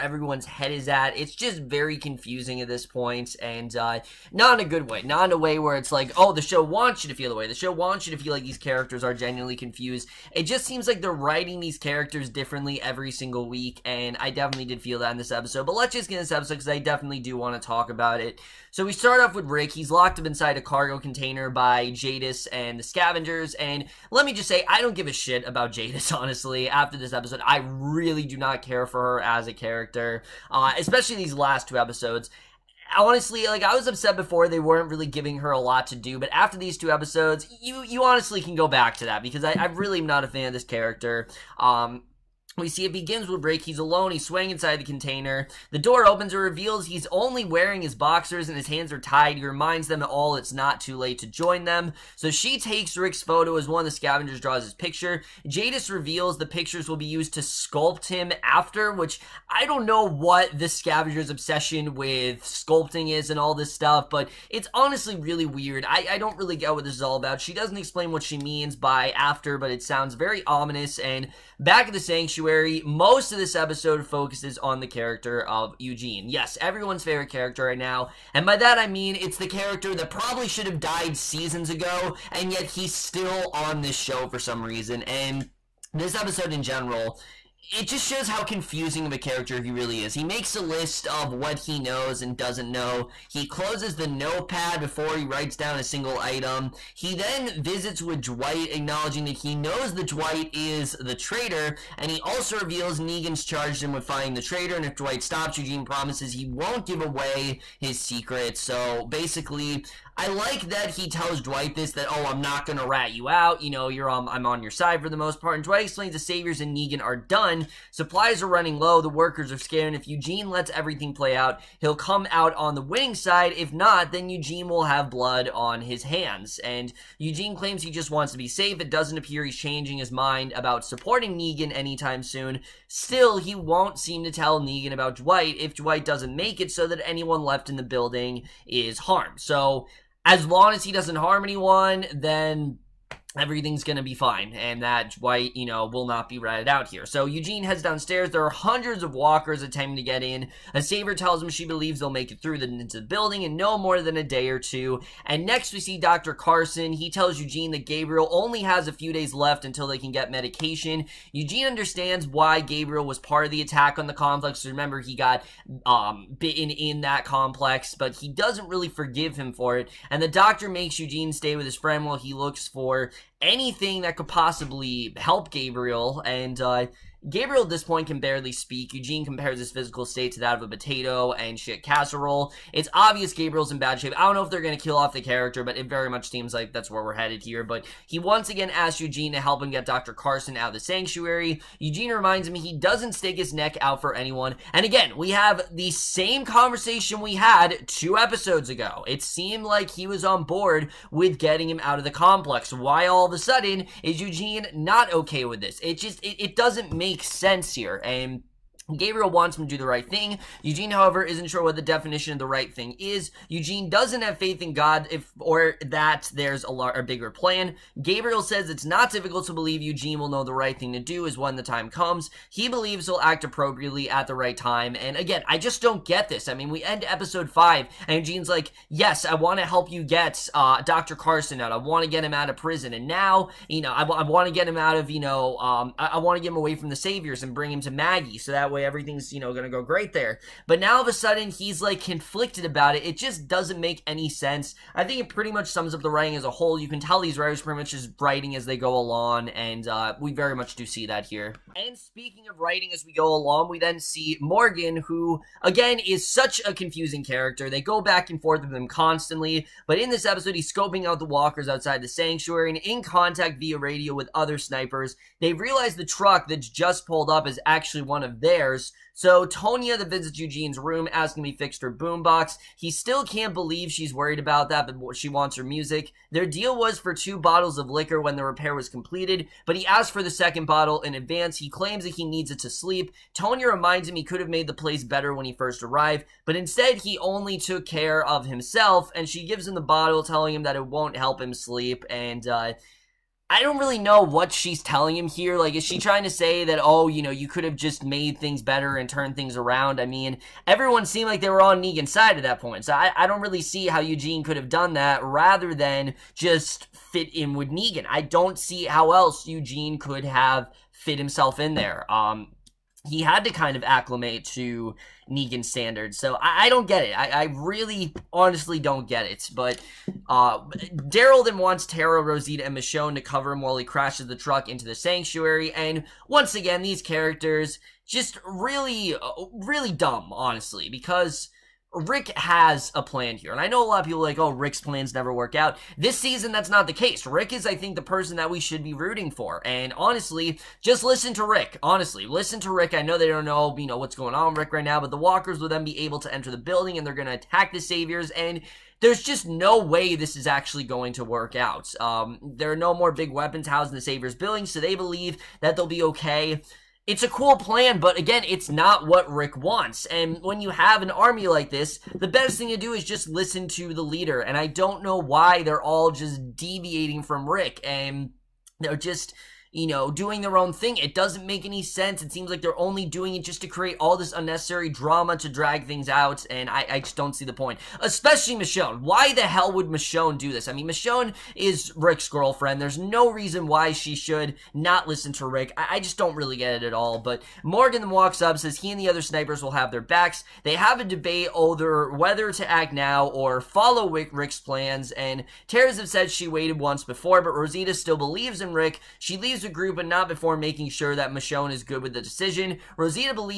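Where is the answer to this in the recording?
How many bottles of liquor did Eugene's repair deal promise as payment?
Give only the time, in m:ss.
4:37.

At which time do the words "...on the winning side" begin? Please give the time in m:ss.
2:02.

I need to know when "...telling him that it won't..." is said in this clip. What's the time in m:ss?
4:50.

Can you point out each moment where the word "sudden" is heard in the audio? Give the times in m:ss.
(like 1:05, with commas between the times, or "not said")
3:23, 4:01.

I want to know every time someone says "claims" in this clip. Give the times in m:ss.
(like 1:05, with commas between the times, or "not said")
2:07, 4:41.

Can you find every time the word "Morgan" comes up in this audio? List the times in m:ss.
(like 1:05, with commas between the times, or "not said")
4:14, 6:27.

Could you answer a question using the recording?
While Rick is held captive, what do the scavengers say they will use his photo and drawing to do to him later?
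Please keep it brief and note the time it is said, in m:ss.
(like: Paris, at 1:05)
Sculpt him, at 0:57.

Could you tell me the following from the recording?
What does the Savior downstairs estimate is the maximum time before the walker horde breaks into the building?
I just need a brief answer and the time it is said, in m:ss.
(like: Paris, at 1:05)
A day or two, at 2:34.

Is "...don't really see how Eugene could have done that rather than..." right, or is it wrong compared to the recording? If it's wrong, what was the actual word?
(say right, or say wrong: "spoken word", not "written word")
right.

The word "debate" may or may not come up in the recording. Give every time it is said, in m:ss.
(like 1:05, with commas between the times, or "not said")
6:31.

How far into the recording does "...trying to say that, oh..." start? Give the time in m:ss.
4:55.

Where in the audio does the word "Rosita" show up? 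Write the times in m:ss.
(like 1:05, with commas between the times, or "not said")
5:22, 6:37, 6:42.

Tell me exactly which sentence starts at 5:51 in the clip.
Um, there are no more big weapons housed in the Saviors building, so they believe that they'll be okay.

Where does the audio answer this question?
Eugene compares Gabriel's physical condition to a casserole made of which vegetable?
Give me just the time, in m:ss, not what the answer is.
3:00.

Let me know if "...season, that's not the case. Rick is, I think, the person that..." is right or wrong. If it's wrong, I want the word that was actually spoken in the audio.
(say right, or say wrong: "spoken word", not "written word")
right.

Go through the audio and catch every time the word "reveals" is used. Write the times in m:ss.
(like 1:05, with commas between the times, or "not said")
0:46, 0:55, 1:42.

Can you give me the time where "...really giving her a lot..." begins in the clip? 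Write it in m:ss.
0:34.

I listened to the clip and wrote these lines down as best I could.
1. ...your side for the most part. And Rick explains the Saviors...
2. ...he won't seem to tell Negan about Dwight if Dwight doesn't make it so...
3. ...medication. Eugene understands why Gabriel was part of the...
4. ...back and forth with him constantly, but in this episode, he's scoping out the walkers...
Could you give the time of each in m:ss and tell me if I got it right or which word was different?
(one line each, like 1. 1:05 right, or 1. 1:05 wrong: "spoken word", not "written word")
1. 1:54 wrong: "Dwight", not "Rick"
2. 2:13 right
3. 2:40 right
4. 4:18 right.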